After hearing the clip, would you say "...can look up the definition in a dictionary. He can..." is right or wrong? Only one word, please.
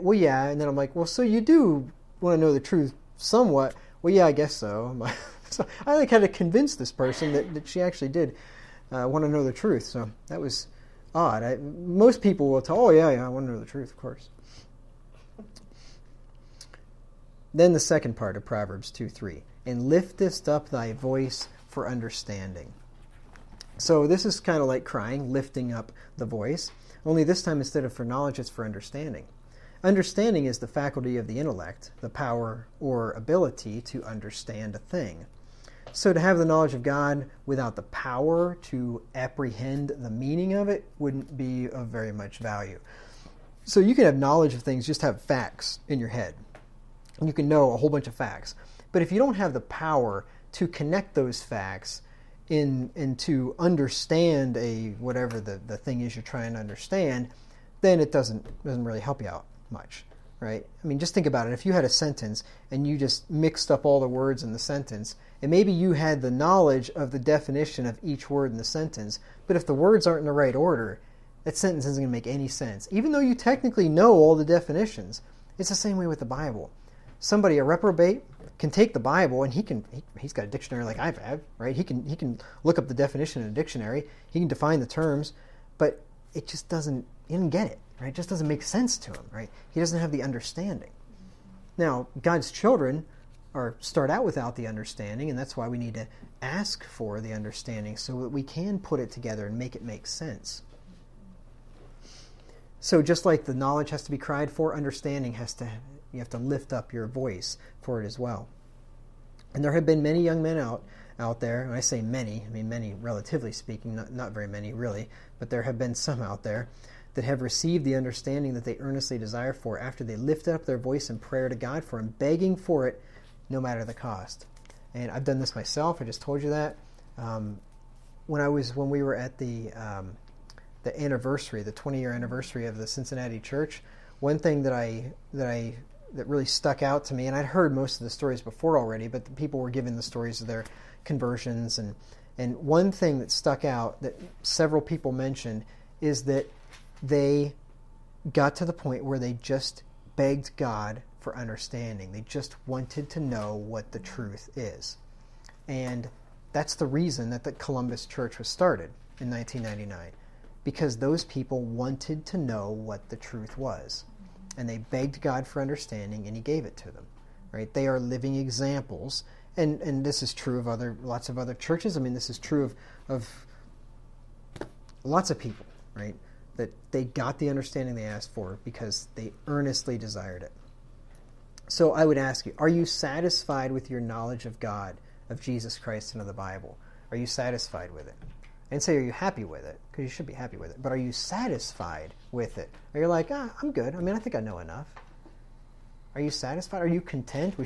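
right.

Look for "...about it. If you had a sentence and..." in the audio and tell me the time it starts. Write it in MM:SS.
01:01.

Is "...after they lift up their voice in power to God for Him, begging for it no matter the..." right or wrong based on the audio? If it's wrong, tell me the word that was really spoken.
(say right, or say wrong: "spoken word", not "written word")
wrong: "prayer", not "power".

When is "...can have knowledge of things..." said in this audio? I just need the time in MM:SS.
00:43.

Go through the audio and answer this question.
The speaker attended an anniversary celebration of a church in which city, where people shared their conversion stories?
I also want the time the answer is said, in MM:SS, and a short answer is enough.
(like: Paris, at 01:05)
Cincinnati, at 02:12.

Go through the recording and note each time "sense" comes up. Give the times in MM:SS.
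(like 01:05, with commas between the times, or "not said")
01:12, 01:28, 01:40.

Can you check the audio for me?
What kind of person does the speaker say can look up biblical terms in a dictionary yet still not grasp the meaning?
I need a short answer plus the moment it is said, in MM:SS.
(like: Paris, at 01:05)
A reprobate, at 01:17.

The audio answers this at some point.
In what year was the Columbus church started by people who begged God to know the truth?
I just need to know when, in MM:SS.
02:39.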